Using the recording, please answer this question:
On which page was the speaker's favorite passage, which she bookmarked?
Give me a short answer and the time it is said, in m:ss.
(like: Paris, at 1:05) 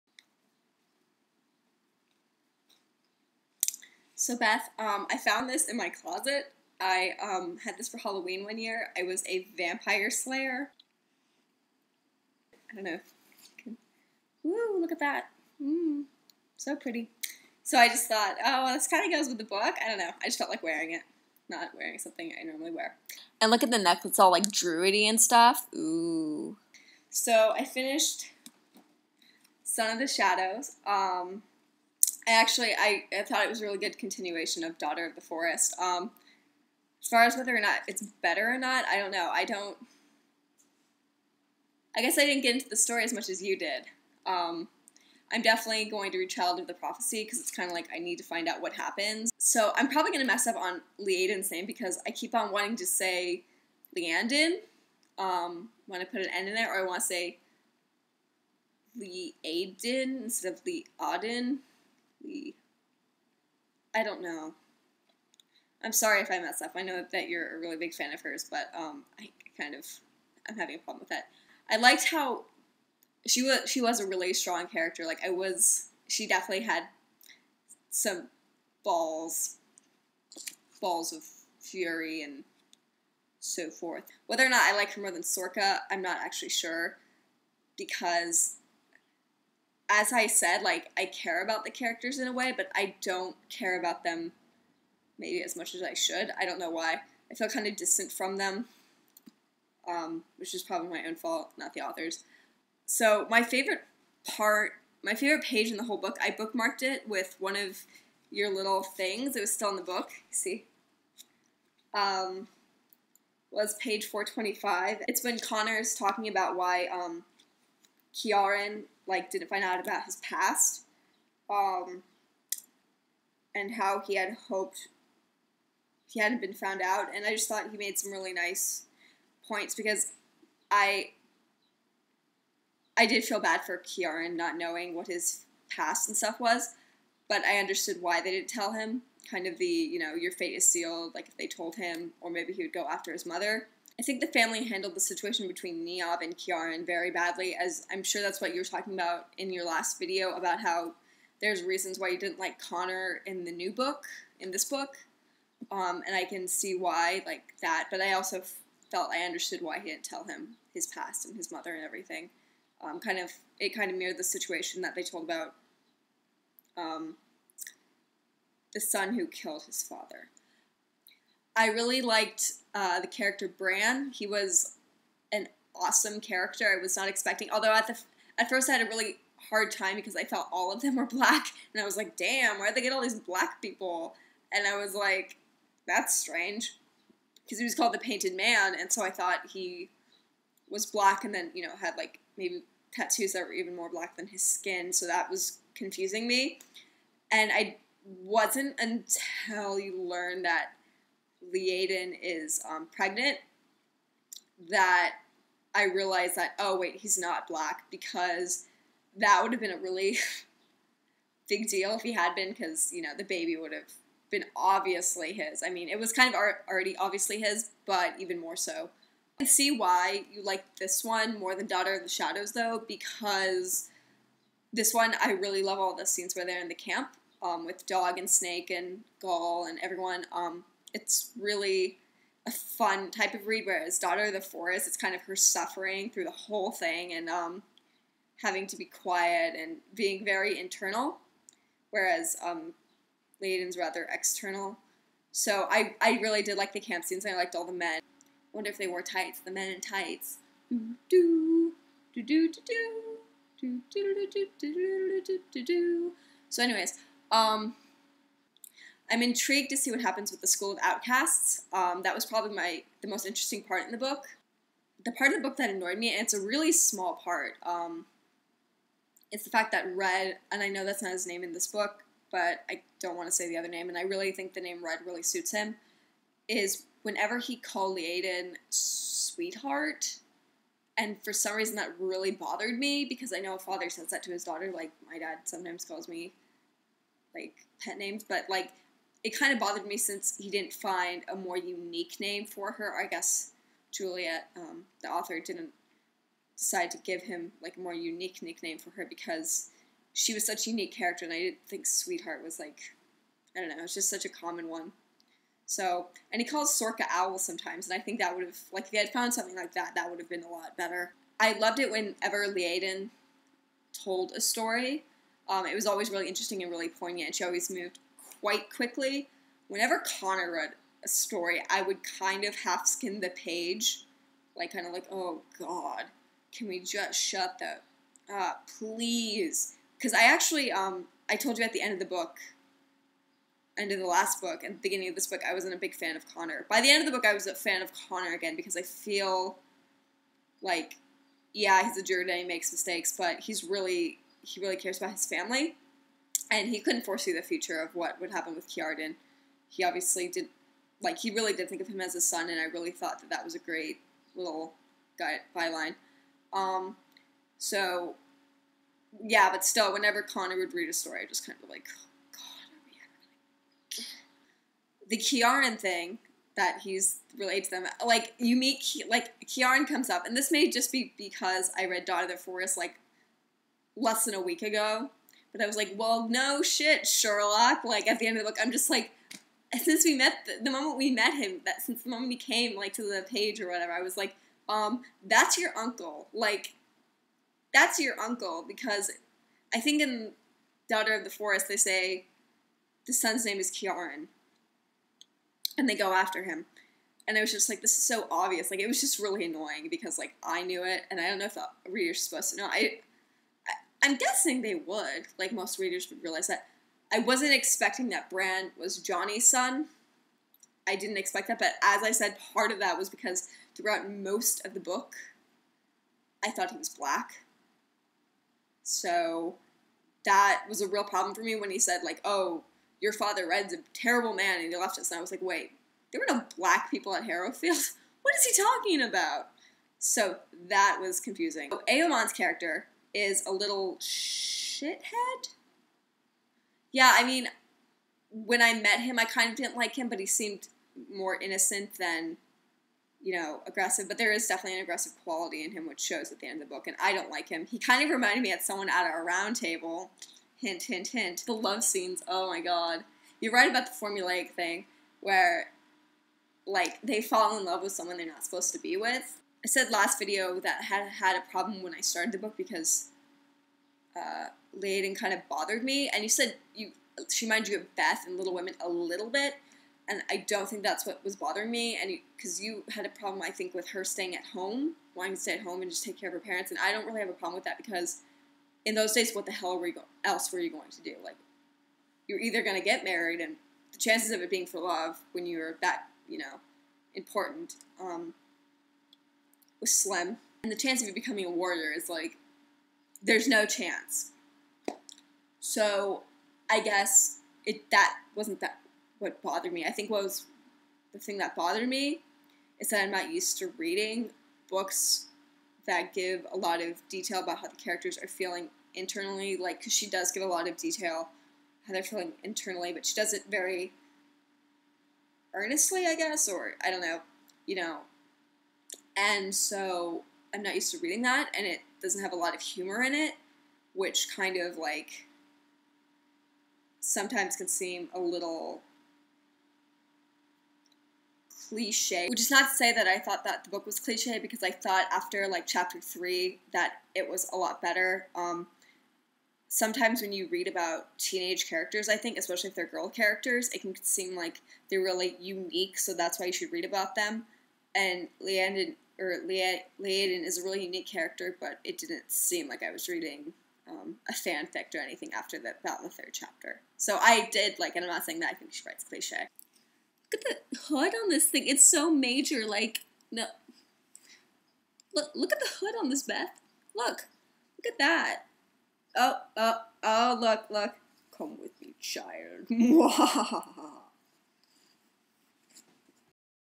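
425, at 1:54.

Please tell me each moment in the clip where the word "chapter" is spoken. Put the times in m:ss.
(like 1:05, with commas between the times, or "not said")
8:55, 9:16.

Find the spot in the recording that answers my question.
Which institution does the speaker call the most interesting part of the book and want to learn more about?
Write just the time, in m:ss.
4:20.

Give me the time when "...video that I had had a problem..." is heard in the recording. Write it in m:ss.
7:40.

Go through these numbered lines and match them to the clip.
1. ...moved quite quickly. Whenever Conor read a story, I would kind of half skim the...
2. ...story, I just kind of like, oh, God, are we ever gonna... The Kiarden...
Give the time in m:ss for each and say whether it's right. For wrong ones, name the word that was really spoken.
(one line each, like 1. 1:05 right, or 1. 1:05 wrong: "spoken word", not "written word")
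1. 5:17 right
2. 6:00 right.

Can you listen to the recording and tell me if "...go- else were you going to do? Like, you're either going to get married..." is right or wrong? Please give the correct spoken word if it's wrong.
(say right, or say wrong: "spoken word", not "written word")
right.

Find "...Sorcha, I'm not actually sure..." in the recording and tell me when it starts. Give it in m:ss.
1:25.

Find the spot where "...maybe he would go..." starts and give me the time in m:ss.
2:22.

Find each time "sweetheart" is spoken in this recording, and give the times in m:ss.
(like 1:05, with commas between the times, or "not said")
4:38, 5:01.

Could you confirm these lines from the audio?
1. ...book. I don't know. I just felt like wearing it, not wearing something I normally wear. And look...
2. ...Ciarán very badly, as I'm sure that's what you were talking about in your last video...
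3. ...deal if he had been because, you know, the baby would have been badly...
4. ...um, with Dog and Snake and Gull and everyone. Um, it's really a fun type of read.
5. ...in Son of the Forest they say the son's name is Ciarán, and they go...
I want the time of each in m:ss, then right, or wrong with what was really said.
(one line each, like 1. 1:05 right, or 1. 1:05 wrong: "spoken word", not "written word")
1. 0:19 right
2. 2:26 right
3. 3:31 wrong: "obviously", not "badly"
4. 3:47 right
5. 6:30 wrong: "Daughter", not "Son".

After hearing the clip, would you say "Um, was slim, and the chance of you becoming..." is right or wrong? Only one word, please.
right.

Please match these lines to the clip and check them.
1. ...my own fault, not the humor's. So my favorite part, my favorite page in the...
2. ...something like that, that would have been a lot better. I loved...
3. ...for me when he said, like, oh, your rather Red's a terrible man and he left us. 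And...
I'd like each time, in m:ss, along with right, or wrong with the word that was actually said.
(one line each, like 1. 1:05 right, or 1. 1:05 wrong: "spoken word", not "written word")
1. 1:40 wrong: "author", not "humor"
2. 5:09 right
3. 7:01 wrong: "father", not "rather".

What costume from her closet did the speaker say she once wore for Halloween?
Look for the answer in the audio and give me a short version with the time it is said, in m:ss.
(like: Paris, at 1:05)
Vampire slayer, at 0:09.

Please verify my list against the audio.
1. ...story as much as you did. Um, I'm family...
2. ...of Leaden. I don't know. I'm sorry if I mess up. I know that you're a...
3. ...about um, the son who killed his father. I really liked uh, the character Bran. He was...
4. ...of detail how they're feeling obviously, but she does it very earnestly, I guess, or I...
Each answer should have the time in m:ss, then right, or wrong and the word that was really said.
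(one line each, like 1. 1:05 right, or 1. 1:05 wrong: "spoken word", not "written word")
1. 0:42 wrong: "definitely", not "family"
2. 1:00 right
3. 2:45 right
4. 8:30 wrong: "internally", not "obviously".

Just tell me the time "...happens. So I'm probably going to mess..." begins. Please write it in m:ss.
0:48.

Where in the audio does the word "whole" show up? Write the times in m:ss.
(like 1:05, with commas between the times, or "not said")
1:45, 3:56.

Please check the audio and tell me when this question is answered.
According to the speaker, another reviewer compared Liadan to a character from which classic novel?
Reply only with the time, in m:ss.
7:48.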